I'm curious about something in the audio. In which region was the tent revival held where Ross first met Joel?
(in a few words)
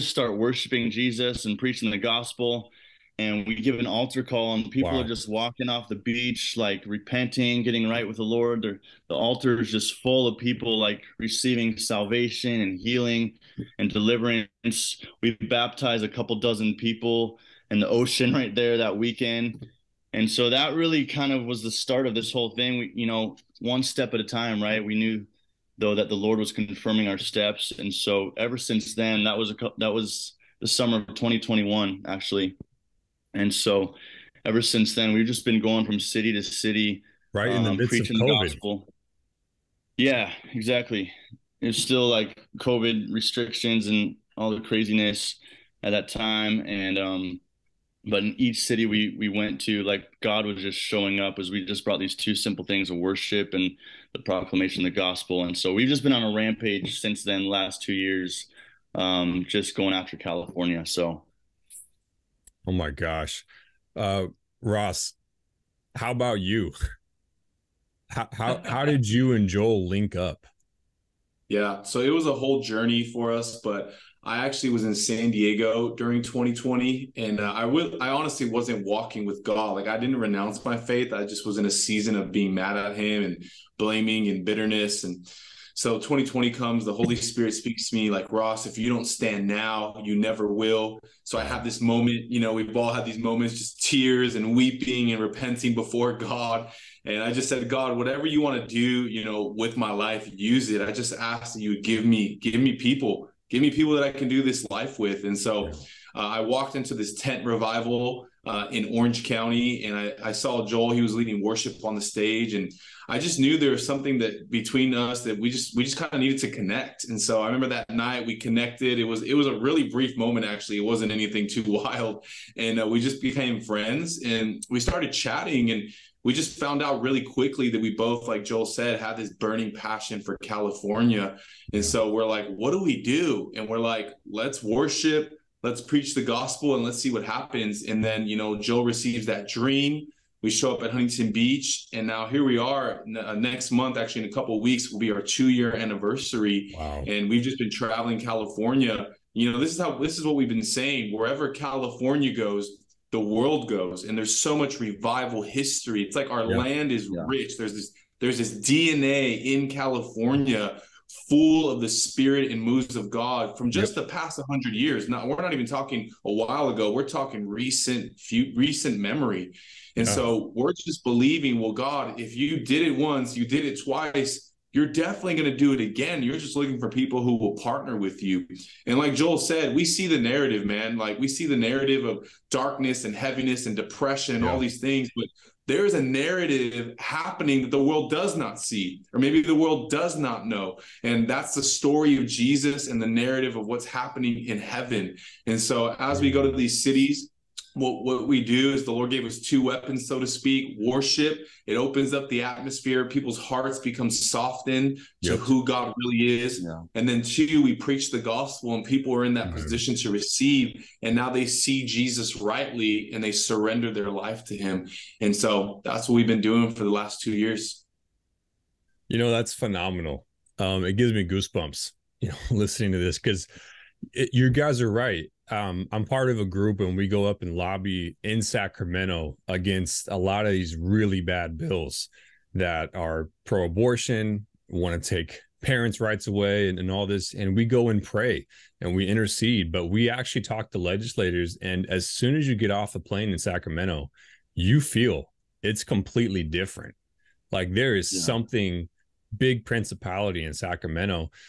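Orange County.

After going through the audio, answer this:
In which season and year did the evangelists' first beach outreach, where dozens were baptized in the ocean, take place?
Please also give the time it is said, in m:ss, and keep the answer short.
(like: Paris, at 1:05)
Summer of 2021, at 0:30.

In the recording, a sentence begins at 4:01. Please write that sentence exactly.
And as soon as you get off the plane in Sacramento, you feel it's completely different.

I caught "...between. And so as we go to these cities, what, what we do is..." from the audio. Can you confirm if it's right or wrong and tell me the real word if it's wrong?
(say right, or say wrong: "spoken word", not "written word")
wrong: "heaven", not "between".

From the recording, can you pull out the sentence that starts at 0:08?
They're, the altar is just full of people, like receiving salvation and healing and deliverance.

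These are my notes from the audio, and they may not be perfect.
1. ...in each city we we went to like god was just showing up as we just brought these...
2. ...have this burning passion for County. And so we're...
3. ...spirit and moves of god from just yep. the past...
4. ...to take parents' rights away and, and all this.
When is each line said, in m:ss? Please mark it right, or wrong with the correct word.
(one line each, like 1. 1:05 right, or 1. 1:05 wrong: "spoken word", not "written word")
1. 0:48 right
2. 2:08 wrong: "California", not "County"
3. 2:41 right
4. 3:55 right.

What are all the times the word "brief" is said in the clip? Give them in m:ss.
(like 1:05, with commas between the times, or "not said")
1:59.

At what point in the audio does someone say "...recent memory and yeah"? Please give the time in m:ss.
2:48.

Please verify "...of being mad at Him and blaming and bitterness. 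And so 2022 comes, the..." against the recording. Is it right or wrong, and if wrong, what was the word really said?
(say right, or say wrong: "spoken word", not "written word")
wrong: "2020", not "2022".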